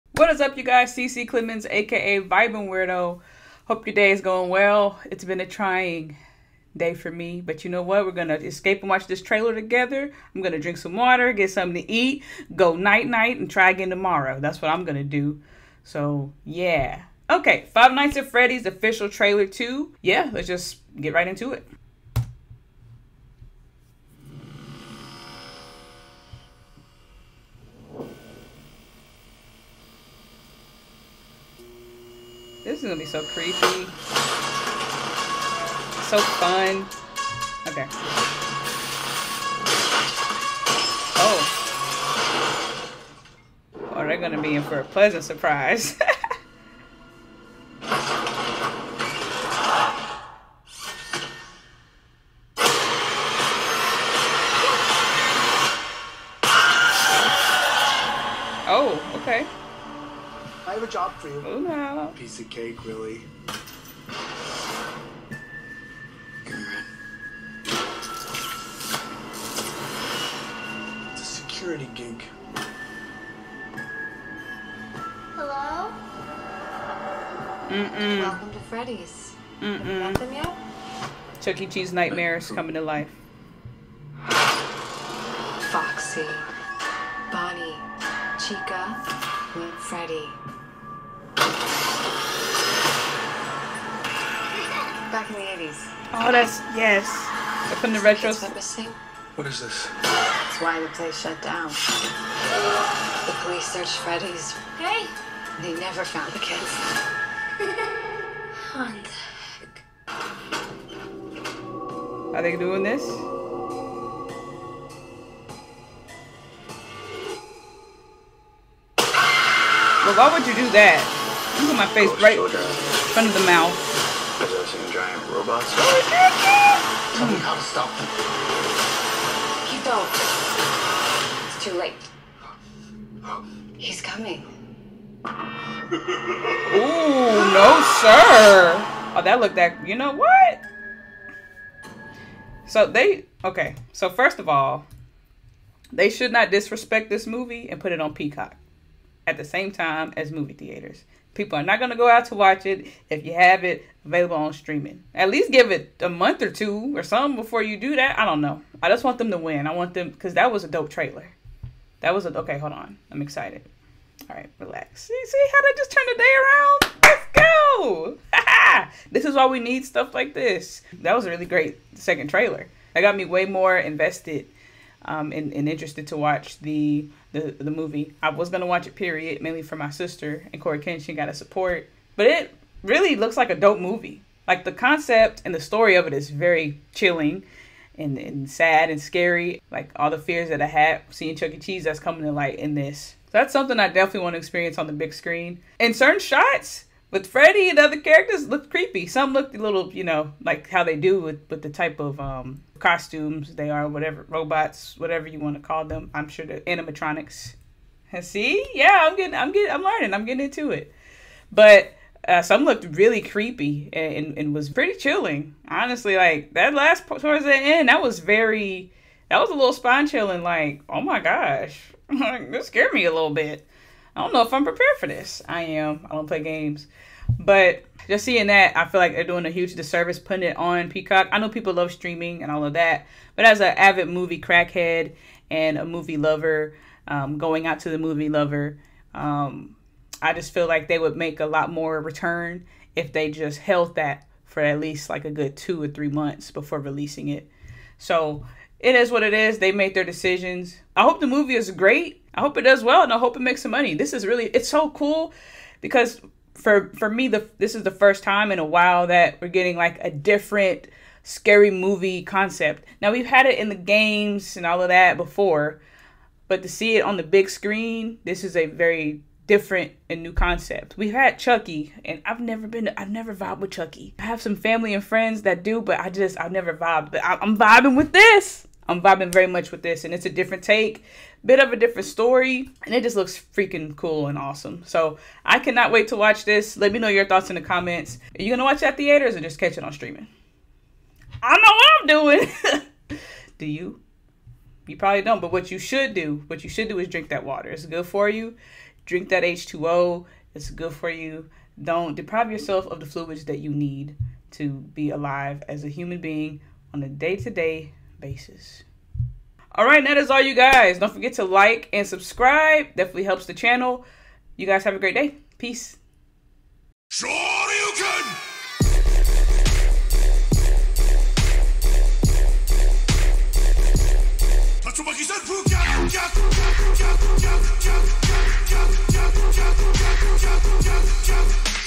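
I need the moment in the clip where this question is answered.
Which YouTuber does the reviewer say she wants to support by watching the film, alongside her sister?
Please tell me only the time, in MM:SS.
03:00.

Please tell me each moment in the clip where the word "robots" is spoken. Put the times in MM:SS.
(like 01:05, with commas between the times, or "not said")
02:05, 03:24.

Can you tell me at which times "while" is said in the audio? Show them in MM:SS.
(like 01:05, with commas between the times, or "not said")
04:18.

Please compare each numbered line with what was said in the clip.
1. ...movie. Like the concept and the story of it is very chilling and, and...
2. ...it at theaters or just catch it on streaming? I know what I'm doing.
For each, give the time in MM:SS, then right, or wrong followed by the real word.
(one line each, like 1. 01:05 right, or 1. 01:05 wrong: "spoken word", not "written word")
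1. 03:03 right
2. 04:48 right.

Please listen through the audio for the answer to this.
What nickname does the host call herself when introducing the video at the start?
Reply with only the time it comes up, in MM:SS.
00:02.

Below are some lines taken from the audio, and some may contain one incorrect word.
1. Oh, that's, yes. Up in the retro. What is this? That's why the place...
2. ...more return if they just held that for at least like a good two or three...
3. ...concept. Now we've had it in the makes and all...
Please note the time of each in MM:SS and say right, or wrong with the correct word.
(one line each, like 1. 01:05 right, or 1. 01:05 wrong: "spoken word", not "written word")
1. 01:36 right
2. 04:01 right
3. 04:22 wrong: "games", not "makes".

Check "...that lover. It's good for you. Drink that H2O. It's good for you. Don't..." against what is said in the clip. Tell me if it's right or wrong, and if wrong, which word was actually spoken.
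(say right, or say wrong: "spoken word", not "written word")
wrong: "water", not "lover".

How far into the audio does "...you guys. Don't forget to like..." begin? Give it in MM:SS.
05:10.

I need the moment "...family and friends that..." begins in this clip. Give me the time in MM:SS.
04:34.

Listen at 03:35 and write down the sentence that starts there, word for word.
Honestly, like that last towards the end, that was very, that was a little spine chilling.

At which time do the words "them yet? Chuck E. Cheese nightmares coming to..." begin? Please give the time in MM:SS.
01:20.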